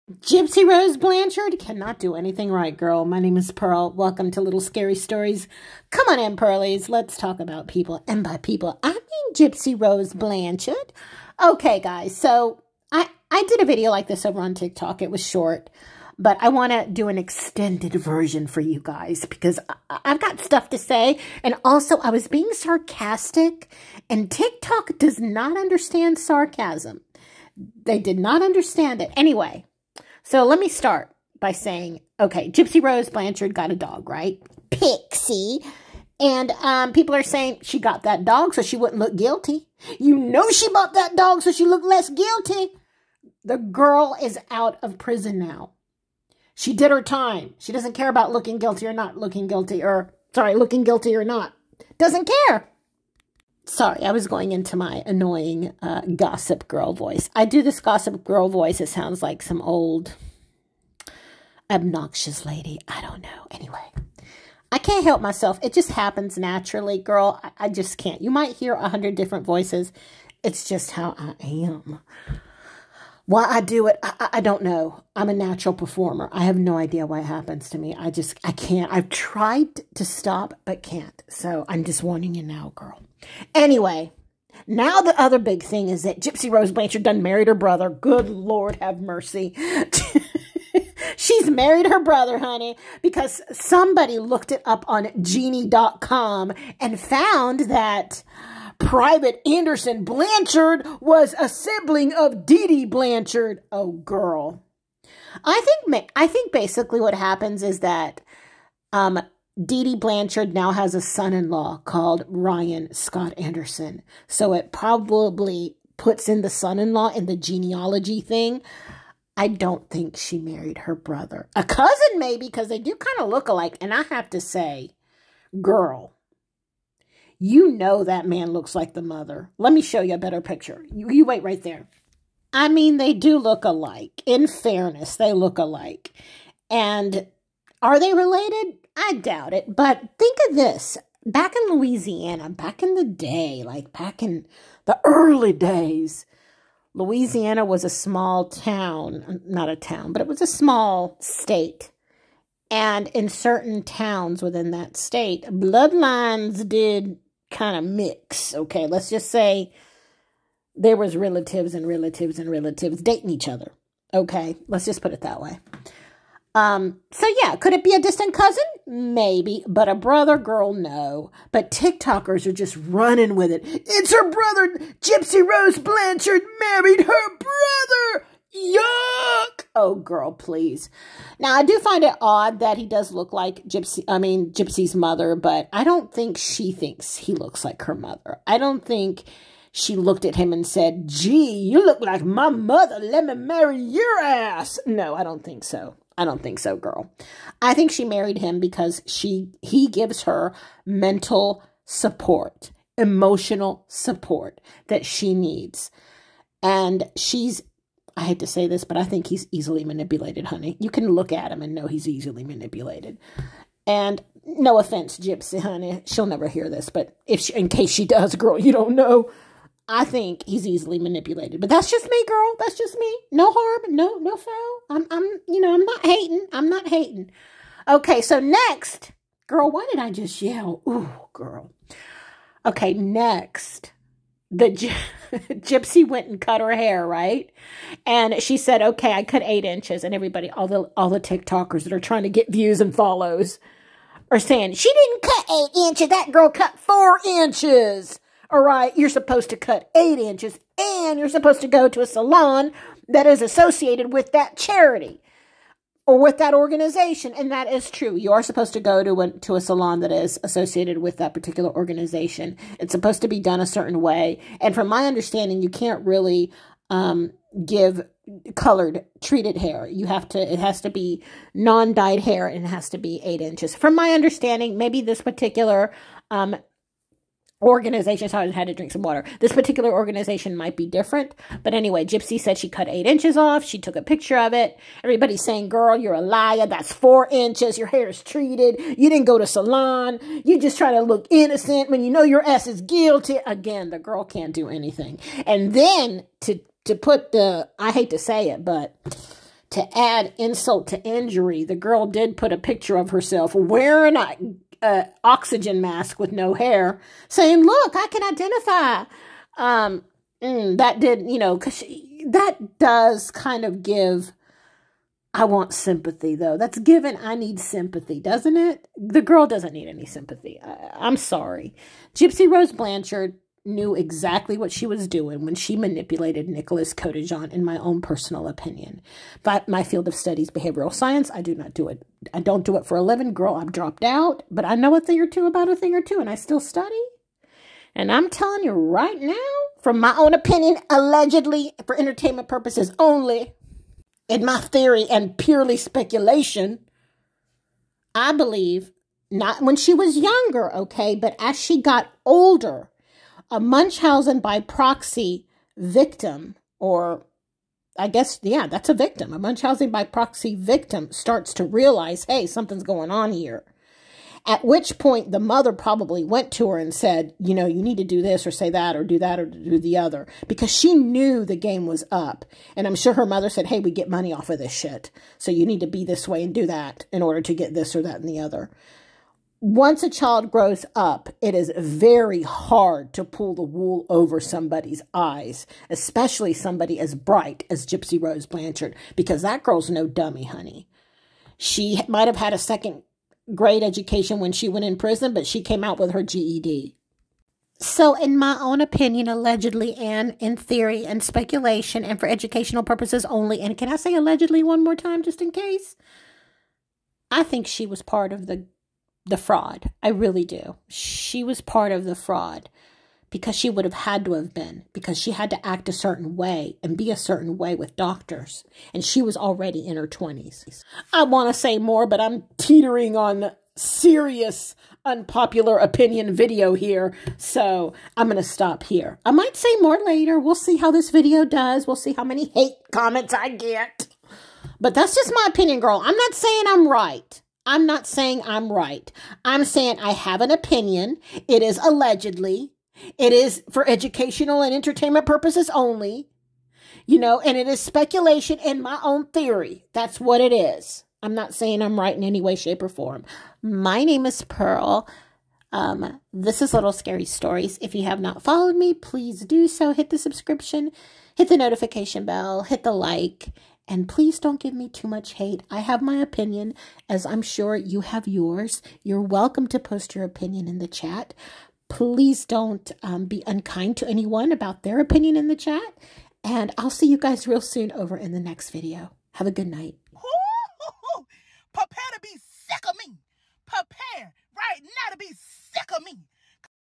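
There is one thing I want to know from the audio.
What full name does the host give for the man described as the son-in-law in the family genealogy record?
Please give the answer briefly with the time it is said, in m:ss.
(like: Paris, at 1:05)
Ryan Scott Anderson, at 1:52.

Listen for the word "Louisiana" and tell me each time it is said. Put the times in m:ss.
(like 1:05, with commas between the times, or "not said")
2:21, 2:26.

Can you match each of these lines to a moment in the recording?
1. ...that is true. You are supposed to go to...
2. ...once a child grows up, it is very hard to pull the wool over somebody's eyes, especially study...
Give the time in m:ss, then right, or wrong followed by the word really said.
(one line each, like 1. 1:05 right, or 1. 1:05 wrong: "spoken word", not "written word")
1. 4:17 right
2. 6:19 wrong: "somebody", not "study".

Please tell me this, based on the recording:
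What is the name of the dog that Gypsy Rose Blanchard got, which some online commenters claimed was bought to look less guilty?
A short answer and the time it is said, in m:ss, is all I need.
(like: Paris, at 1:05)
Pixie, at 0:34.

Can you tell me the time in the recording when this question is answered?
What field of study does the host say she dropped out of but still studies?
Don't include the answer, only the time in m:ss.
5:30.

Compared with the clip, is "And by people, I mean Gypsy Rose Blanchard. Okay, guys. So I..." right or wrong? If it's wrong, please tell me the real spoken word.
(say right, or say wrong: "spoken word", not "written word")
right.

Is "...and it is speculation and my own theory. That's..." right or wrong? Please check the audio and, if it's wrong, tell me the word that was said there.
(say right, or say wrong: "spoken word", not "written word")
right.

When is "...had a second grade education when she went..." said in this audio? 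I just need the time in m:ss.
6:32.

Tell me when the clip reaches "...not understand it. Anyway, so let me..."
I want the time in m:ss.
0:28.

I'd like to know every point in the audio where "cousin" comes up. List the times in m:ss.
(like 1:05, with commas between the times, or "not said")
2:01, 2:48.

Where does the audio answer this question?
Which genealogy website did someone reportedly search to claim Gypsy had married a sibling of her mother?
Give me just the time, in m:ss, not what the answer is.
1:35.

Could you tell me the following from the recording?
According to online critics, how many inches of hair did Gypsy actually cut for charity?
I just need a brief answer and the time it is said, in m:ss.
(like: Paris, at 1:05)
4 inches, at 4:06.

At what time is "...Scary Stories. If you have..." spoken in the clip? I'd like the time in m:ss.
7:36.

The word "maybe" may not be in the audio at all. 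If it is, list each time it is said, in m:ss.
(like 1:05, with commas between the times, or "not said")
2:02, 2:48, 4:34.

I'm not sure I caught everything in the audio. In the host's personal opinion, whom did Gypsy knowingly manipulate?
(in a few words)
Nicholas Godejohn.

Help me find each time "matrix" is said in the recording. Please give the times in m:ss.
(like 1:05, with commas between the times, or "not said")
not said.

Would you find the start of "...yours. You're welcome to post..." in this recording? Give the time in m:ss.
7:48.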